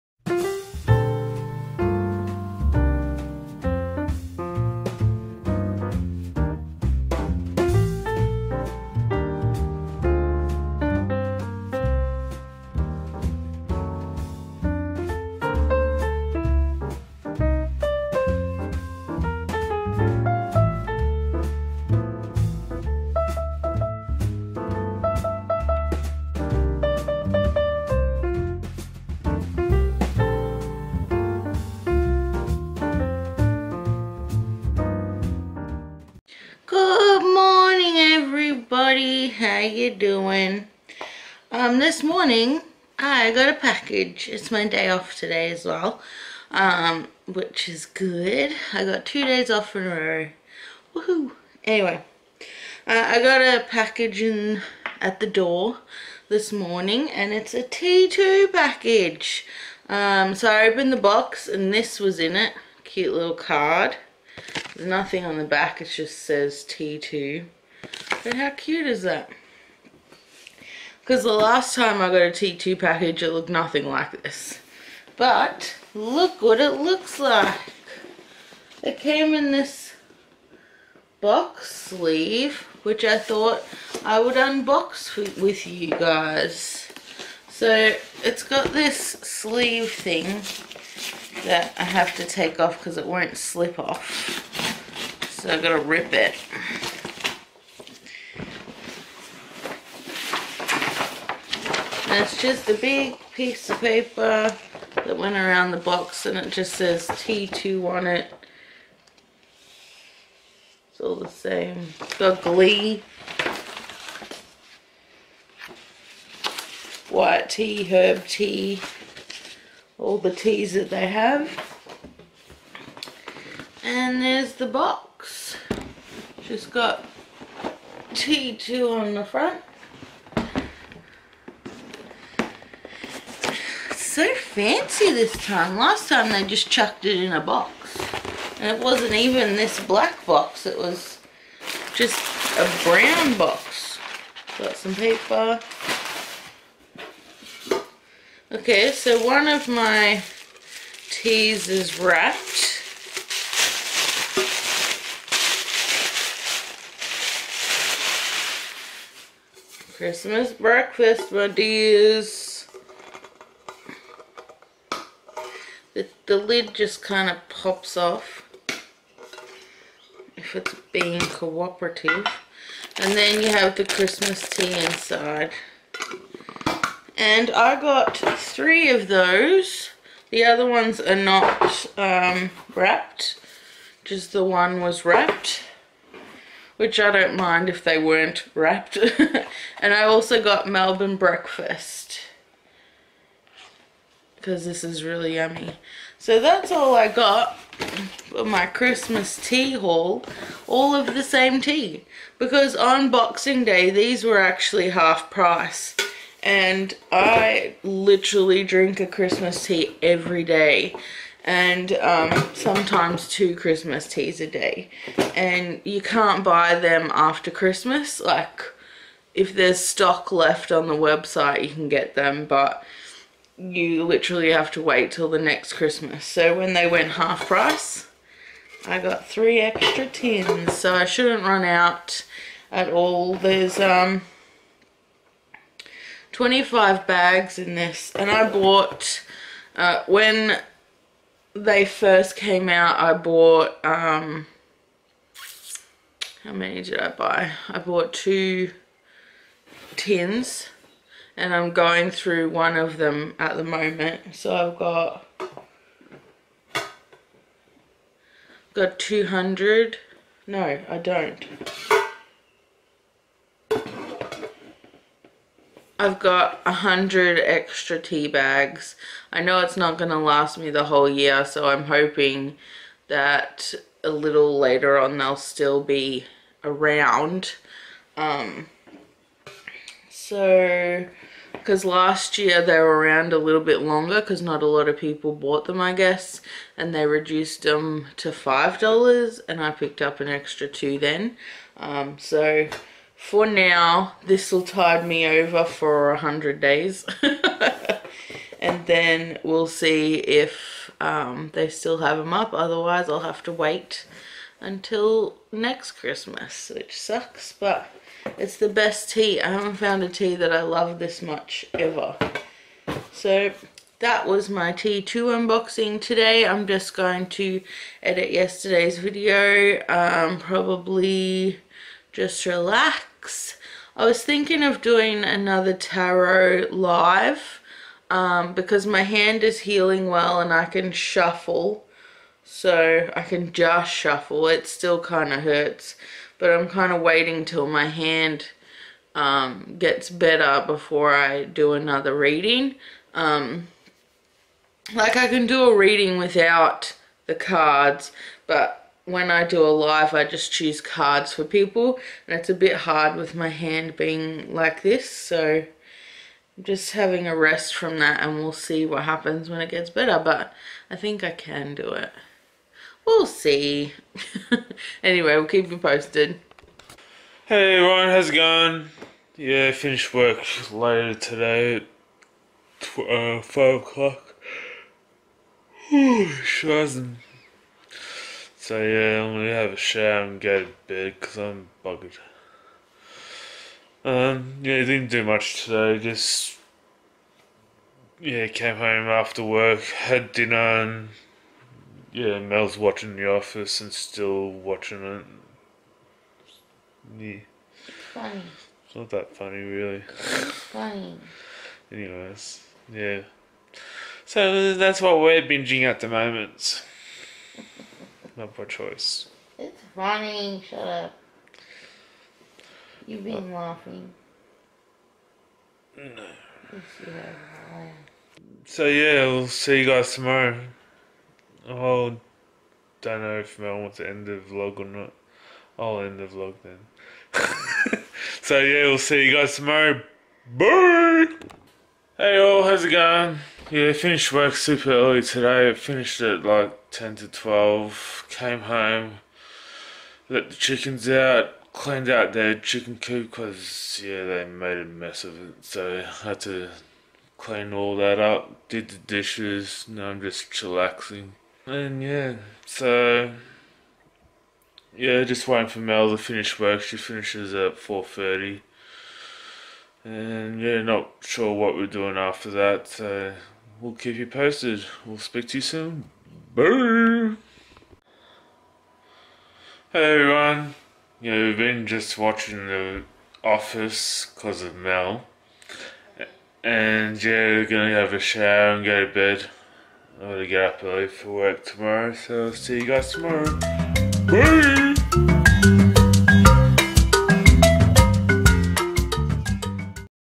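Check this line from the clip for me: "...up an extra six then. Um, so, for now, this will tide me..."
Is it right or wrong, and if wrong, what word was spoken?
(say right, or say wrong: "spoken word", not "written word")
wrong: "two", not "six".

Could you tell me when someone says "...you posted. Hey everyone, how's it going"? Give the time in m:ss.
6:05.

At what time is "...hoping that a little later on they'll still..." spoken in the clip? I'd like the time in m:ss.
4:31.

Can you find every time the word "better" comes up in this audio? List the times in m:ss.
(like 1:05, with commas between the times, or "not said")
5:40, 5:59.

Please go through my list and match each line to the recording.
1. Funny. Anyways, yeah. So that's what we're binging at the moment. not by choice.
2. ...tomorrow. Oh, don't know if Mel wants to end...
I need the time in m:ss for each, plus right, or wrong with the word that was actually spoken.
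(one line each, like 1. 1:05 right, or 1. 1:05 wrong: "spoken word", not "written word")
1. 6:40 right
2. 7:00 right.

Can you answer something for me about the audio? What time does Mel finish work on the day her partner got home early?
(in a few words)
4:30.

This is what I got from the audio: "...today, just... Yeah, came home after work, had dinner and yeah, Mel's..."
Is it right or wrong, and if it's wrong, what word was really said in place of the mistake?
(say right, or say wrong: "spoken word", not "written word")
right.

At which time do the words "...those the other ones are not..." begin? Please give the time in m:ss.
2:59.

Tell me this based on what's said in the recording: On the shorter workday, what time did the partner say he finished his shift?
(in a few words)
10 to 12.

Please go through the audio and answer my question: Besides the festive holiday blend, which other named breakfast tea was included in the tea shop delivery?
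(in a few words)
Melbourne breakfast.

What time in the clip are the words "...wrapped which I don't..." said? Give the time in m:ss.
3:05.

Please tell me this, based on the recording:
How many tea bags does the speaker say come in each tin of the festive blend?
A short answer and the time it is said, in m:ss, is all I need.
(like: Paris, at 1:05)
25, at 3:56.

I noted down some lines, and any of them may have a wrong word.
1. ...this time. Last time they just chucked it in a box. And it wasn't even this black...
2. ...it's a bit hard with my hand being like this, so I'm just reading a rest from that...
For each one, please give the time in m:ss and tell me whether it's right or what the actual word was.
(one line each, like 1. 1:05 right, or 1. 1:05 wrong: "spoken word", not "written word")
1. 2:15 right
2. 5:52 wrong: "having", not "reading".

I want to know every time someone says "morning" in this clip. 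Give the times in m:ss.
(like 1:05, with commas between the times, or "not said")
0:42, 0:56.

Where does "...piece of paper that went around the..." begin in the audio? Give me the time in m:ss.
1:43.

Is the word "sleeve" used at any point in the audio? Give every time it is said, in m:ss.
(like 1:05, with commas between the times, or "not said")
1:21, 1:28.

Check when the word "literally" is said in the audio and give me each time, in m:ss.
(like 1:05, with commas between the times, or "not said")
3:27, 3:44.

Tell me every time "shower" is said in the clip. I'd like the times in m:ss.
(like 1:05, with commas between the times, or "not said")
6:19, 7:58.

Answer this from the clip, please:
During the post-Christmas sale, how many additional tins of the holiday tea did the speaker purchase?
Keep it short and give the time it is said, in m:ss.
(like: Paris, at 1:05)
3, at 3:49.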